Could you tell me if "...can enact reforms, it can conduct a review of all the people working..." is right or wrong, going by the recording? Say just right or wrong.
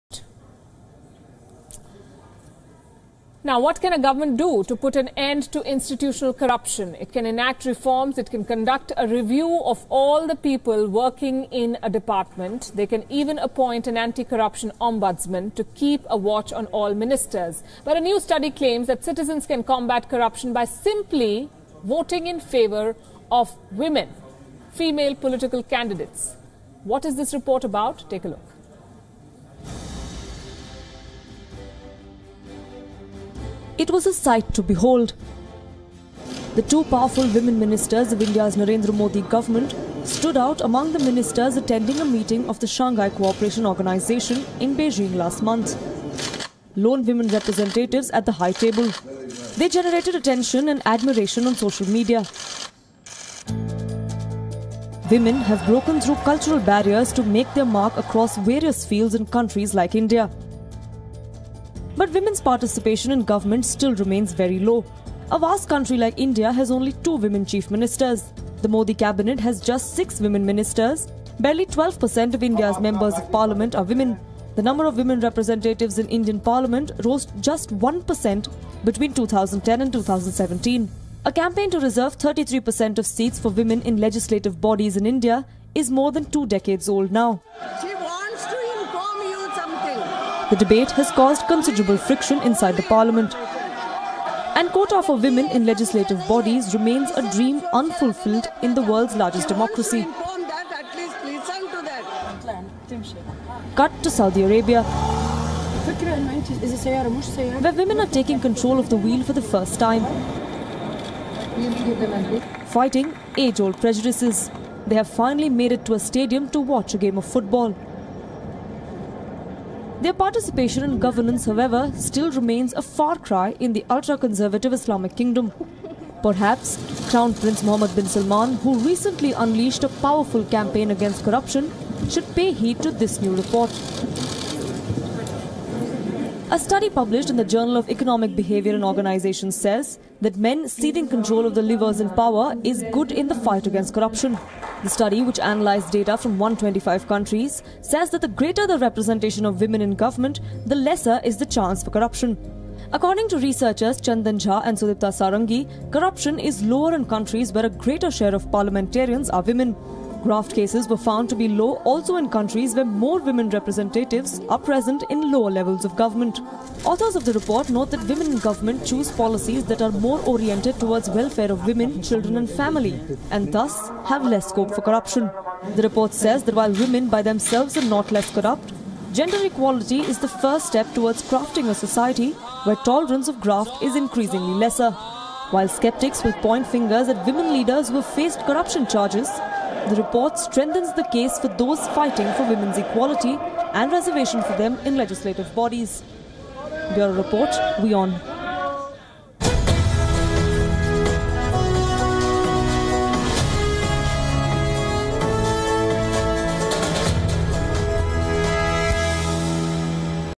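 right.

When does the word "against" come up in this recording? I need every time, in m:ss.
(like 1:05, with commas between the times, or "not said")
2:10, 2:23.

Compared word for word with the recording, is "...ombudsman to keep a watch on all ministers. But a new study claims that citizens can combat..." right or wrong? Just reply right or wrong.
right.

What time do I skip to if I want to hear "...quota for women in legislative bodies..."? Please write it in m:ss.
1:34.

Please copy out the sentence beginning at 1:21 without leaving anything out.
A campaign to reserve 33% of seats for women in legislative bodies in India is more than two decades old now.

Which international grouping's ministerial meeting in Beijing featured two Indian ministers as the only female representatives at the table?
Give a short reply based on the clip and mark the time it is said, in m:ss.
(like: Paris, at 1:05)
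Shanghai Cooperation Organization, at 0:42.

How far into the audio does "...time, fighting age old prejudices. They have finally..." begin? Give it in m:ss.
1:49.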